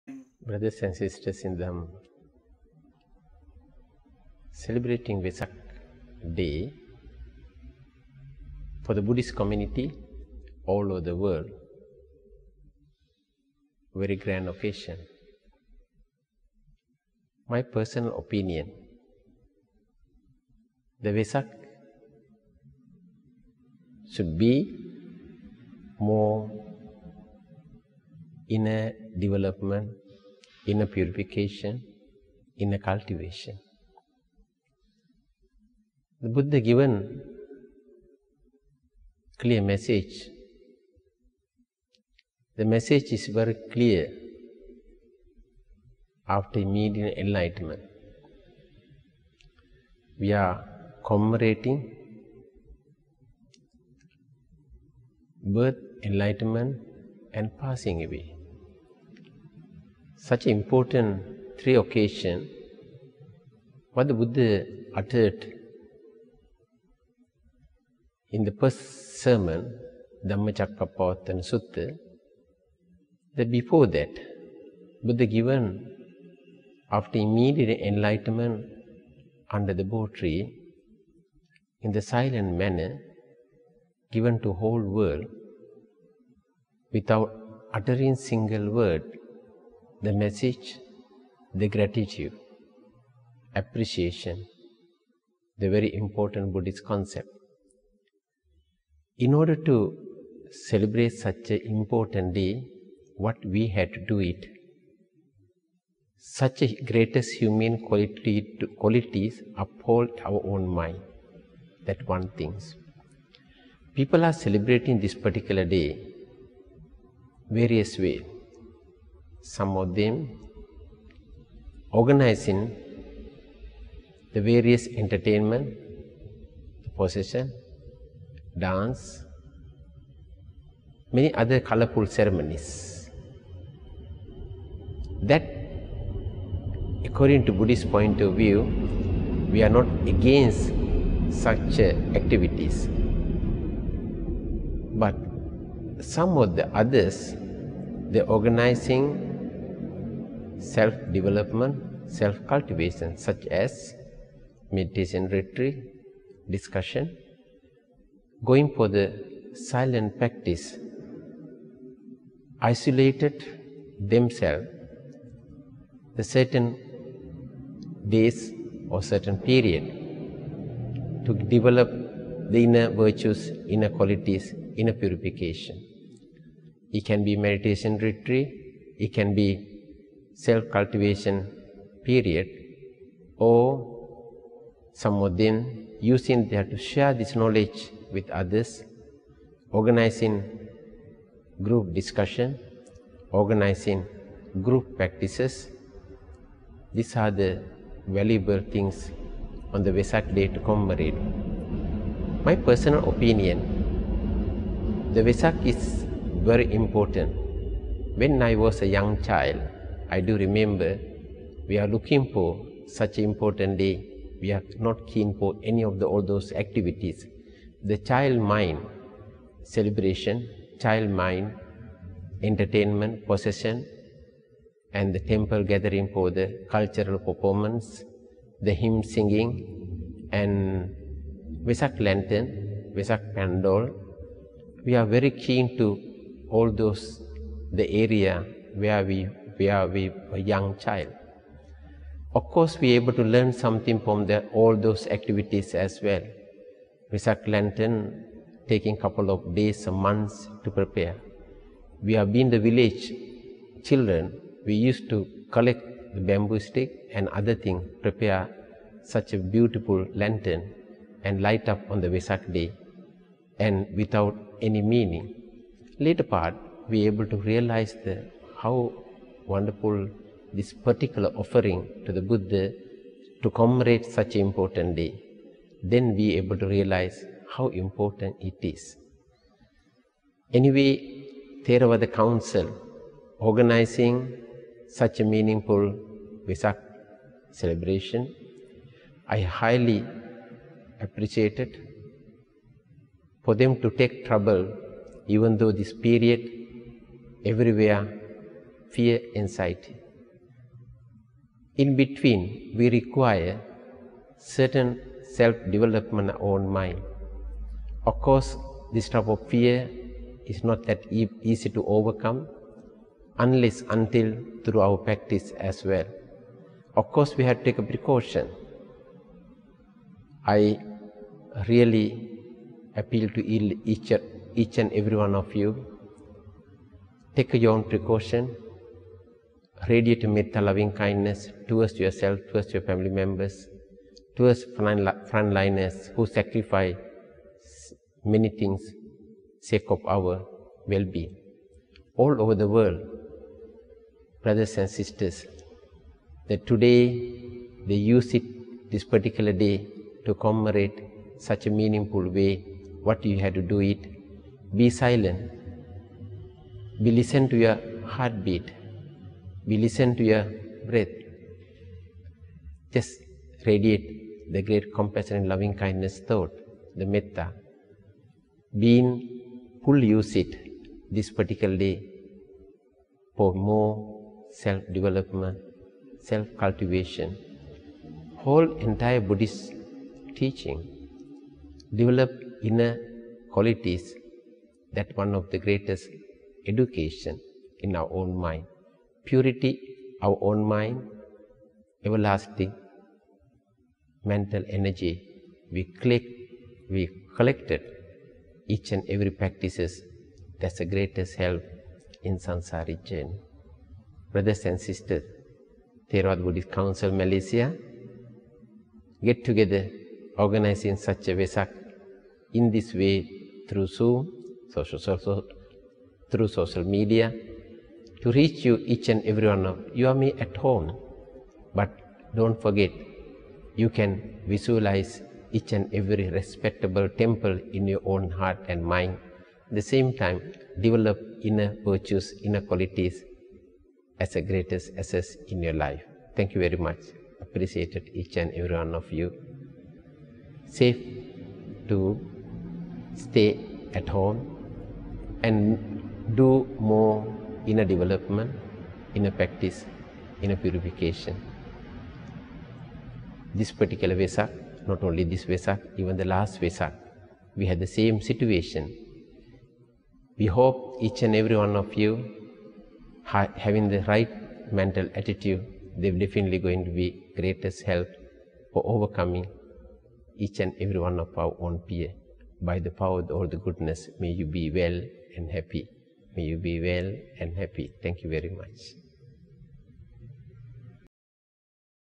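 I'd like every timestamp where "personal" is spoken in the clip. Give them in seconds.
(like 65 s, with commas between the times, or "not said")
17 s, 202 s.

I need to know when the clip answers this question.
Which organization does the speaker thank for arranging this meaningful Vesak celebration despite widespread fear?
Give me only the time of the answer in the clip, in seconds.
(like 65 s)
281 s.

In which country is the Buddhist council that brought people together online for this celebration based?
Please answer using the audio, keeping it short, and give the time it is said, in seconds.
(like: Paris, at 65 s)
Malaysia, at 407 s.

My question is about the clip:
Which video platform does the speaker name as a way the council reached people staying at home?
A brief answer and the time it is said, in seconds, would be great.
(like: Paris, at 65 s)
Zoom, at 413 s.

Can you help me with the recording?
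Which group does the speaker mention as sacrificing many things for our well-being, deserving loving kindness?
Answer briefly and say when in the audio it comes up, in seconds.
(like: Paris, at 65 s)
frontliners, at 334 s.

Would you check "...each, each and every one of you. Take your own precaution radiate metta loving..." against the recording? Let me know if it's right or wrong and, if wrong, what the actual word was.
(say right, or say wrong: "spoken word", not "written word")
right.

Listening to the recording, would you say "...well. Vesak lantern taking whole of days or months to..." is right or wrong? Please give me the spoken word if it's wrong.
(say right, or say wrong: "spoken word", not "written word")
wrong: "couple", not "whole".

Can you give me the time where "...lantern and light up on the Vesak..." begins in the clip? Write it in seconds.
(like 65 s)
260 s.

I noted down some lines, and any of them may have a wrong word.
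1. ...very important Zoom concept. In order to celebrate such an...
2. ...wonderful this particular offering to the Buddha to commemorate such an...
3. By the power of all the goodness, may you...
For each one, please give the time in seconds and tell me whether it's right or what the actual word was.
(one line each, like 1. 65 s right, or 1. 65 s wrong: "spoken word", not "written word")
1. 95 s wrong: "Buddhist", not "Zoom"
2. 269 s right
3. 472 s right.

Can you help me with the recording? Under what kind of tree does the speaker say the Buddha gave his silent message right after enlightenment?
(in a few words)
Bo tree.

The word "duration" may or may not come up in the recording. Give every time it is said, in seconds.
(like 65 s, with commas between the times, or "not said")
not said.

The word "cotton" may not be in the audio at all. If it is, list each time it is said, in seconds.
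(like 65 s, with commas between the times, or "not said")
not said.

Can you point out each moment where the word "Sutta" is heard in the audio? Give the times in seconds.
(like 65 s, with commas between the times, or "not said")
71 s.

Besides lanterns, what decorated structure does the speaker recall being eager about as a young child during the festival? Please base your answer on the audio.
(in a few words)
Vesak pandal.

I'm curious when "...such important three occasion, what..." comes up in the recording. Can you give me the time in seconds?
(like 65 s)
60 s.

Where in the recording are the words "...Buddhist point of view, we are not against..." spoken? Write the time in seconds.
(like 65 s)
137 s.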